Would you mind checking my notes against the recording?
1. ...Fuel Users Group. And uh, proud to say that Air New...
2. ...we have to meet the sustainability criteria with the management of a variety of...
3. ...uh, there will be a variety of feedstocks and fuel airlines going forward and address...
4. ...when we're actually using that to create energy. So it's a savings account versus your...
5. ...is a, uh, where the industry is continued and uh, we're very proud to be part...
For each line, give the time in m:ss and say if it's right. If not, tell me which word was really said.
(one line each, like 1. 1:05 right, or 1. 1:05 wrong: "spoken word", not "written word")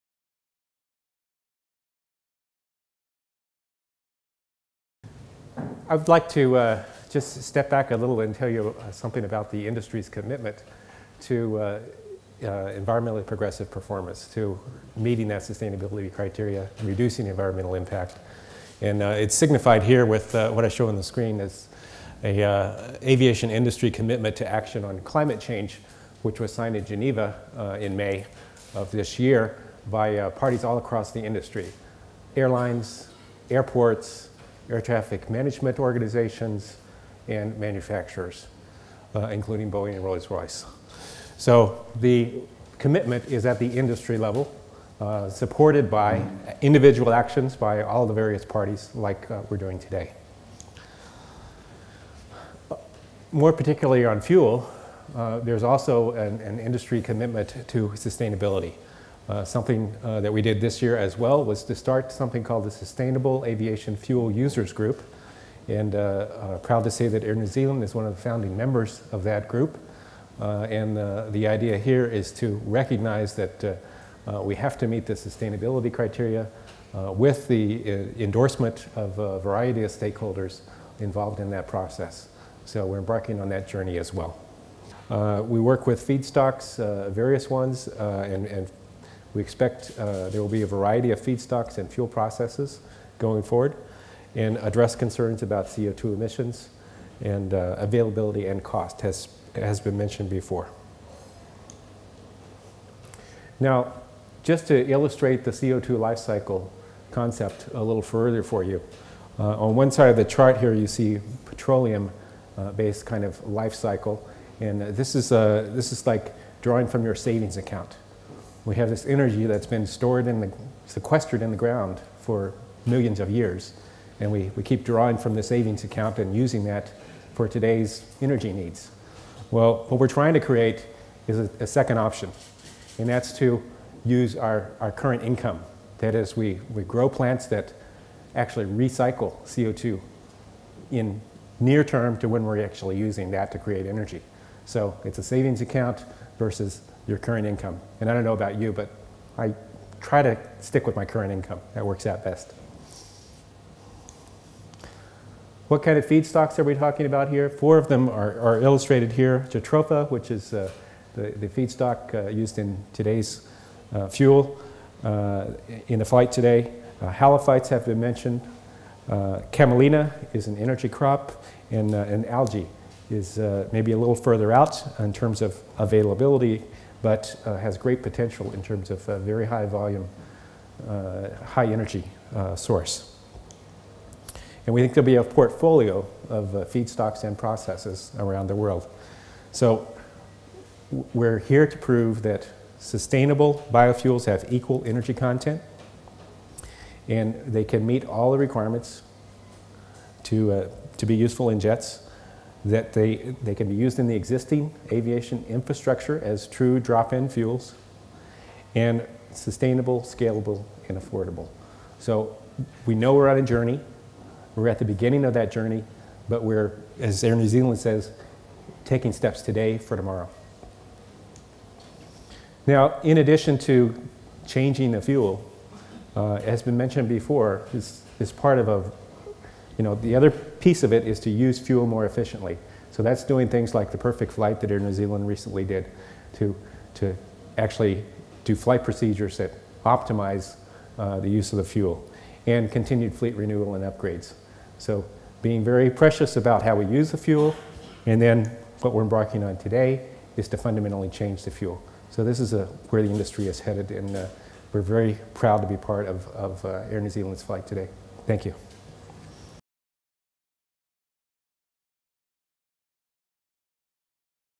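1. 1:03 right
2. 1:14 wrong: "endorsement", not "management"
3. 1:29 wrong: "processes", not "airlines"
4. 2:22 right
5. 4:12 wrong: "headed", not "continued".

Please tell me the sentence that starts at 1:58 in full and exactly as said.
We have this energy that's been stored in the, sequestered in the ground for millions of years.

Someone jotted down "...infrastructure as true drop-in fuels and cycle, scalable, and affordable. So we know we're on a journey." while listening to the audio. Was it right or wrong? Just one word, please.
wrong.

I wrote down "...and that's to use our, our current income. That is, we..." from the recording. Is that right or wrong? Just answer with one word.
right.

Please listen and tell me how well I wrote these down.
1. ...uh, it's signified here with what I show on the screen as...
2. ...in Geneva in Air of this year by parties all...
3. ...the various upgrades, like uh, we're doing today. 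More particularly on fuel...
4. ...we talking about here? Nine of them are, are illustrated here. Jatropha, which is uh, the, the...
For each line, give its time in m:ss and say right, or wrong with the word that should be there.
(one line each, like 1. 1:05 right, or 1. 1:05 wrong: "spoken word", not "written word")
1. 0:19 right
2. 0:26 wrong: "May", not "Air"
3. 0:48 wrong: "parties", not "upgrades"
4. 2:36 wrong: "Four", not "Nine".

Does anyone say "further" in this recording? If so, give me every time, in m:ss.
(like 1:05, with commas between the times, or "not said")
1:48, 2:54.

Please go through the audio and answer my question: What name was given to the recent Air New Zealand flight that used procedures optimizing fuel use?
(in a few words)
the perfect flight.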